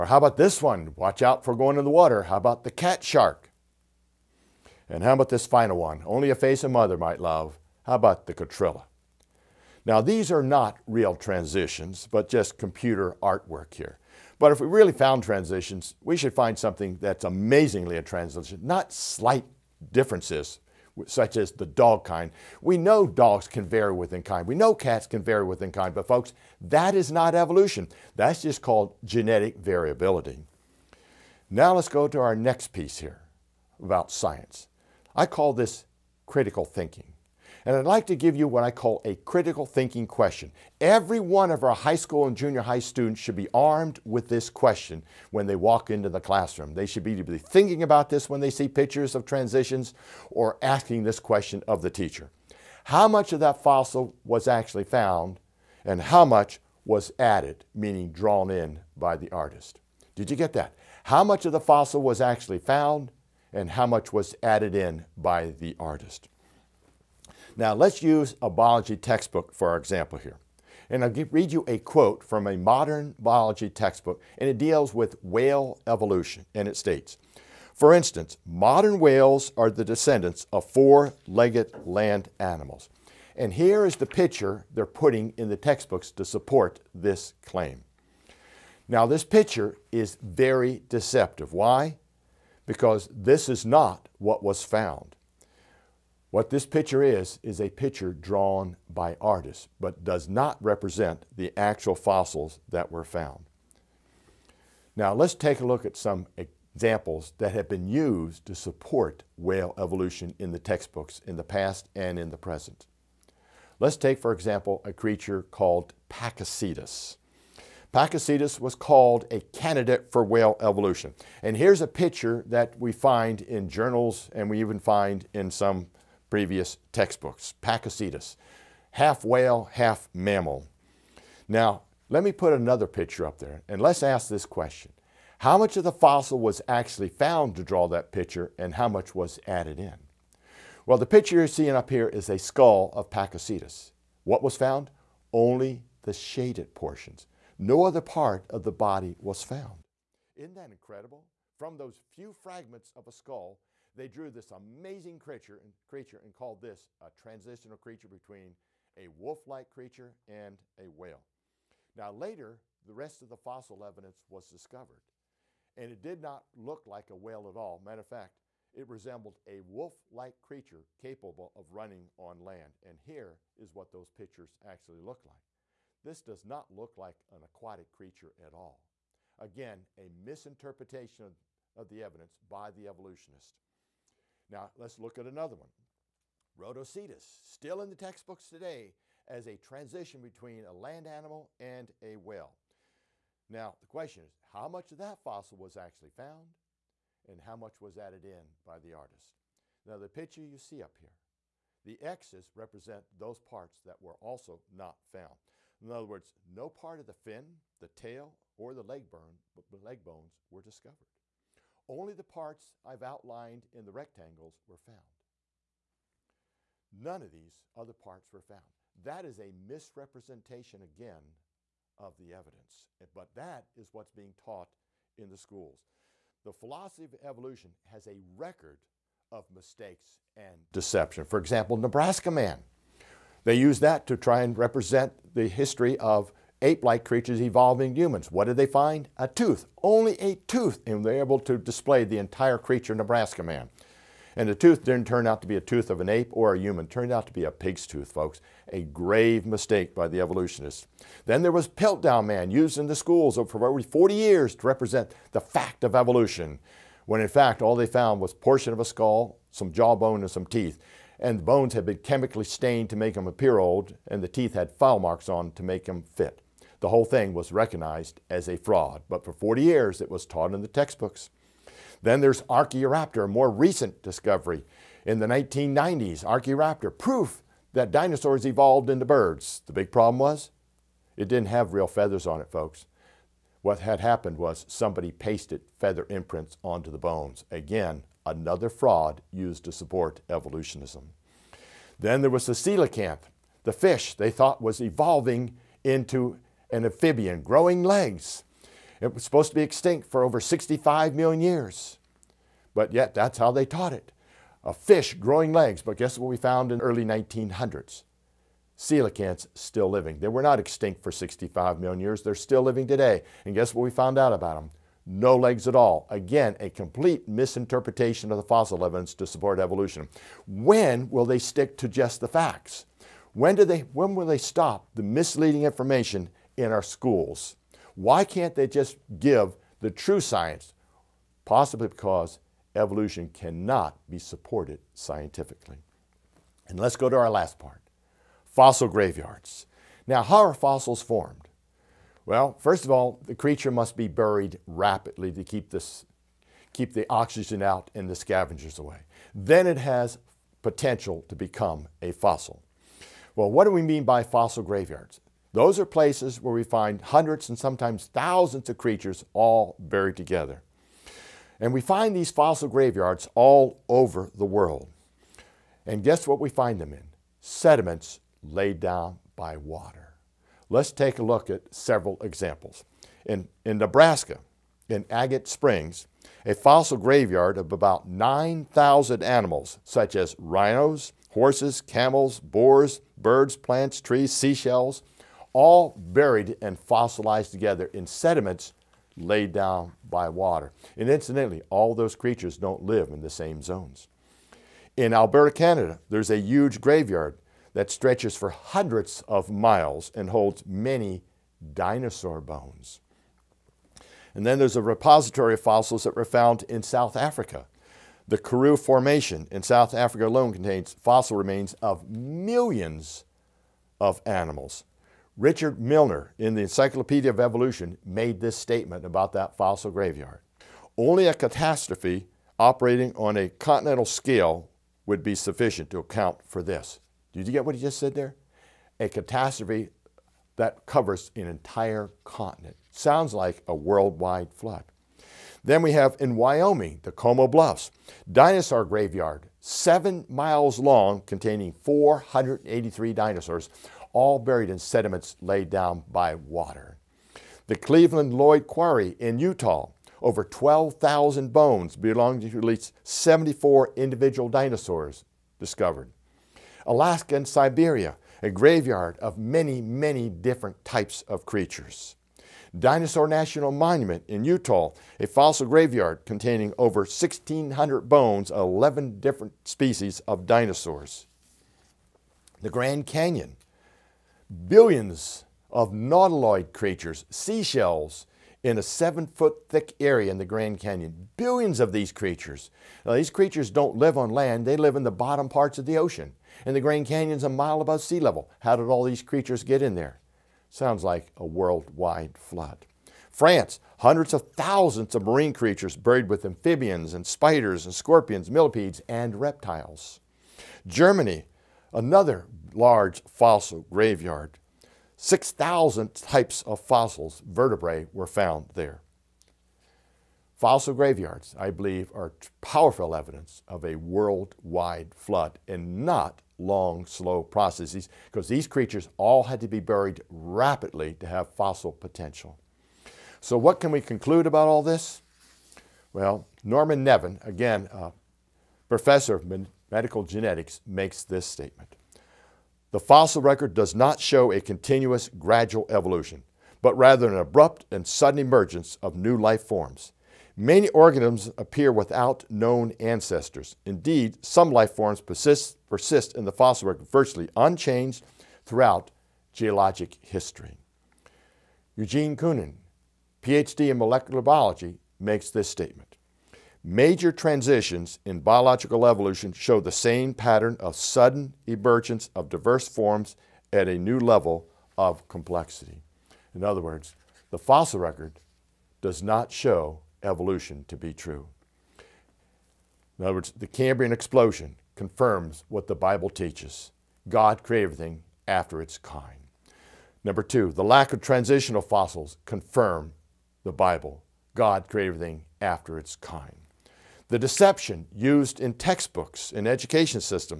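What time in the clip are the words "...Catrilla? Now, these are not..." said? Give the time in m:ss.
0:08.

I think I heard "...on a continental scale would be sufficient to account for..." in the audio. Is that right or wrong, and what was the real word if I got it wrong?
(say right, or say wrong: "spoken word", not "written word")
right.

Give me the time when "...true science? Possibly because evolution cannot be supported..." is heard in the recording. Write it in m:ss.
5:29.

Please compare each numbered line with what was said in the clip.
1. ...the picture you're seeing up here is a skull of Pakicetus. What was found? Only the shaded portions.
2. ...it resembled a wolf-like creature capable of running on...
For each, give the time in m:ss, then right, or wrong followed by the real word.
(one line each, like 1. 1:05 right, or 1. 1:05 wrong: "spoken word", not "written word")
1. 2:20 right
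2. 2:48 right.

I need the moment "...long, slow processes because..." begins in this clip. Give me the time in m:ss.
8:36.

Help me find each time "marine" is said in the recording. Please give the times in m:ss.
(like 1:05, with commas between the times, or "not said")
8:15.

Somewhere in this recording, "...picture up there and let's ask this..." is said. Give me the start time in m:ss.
2:12.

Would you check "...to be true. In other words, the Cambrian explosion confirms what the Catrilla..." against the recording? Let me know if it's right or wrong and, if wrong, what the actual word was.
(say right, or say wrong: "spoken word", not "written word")
wrong: "Bible", not "Catrilla".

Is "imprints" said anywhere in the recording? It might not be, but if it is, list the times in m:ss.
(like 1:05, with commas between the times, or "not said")
4:46.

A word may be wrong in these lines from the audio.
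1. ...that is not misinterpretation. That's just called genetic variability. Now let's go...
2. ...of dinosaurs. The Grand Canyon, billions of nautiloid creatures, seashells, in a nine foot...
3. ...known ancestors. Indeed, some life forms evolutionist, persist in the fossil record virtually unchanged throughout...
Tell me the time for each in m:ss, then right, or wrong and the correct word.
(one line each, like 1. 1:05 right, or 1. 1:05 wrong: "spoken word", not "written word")
1. 0:26 wrong: "evolution", not "misinterpretation"
2. 7:50 wrong: "seven", not "nine"
3. 9:02 wrong: "persist", not "evolutionist".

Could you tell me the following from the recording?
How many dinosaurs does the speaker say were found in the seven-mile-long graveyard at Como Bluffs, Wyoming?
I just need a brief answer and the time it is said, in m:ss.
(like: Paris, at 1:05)
483, at 7:21.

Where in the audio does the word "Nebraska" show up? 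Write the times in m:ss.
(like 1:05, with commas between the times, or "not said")
3:51, 4:02, 6:13.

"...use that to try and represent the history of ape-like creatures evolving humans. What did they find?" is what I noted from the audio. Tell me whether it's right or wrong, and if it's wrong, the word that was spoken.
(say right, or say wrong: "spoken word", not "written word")
right.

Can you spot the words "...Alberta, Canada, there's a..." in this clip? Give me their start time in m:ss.
6:35.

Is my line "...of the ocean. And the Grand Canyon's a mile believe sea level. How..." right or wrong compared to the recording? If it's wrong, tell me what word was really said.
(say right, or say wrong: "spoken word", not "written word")
wrong: "above", not "believe".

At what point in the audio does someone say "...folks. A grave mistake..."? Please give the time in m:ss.
4:08.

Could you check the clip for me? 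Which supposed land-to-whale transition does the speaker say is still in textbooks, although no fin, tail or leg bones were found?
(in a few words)
Rodhocetus.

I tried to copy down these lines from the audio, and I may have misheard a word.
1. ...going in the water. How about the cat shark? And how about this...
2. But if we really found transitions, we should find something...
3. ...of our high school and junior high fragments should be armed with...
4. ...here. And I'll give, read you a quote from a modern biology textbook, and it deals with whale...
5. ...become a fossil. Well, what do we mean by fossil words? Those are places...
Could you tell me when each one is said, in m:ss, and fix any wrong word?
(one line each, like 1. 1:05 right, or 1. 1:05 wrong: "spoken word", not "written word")
1. 0:01 right
2. 0:14 right
3. 0:41 wrong: "students", not "fragments"
4. 1:10 right
5. 5:51 wrong: "graveyards", not "words".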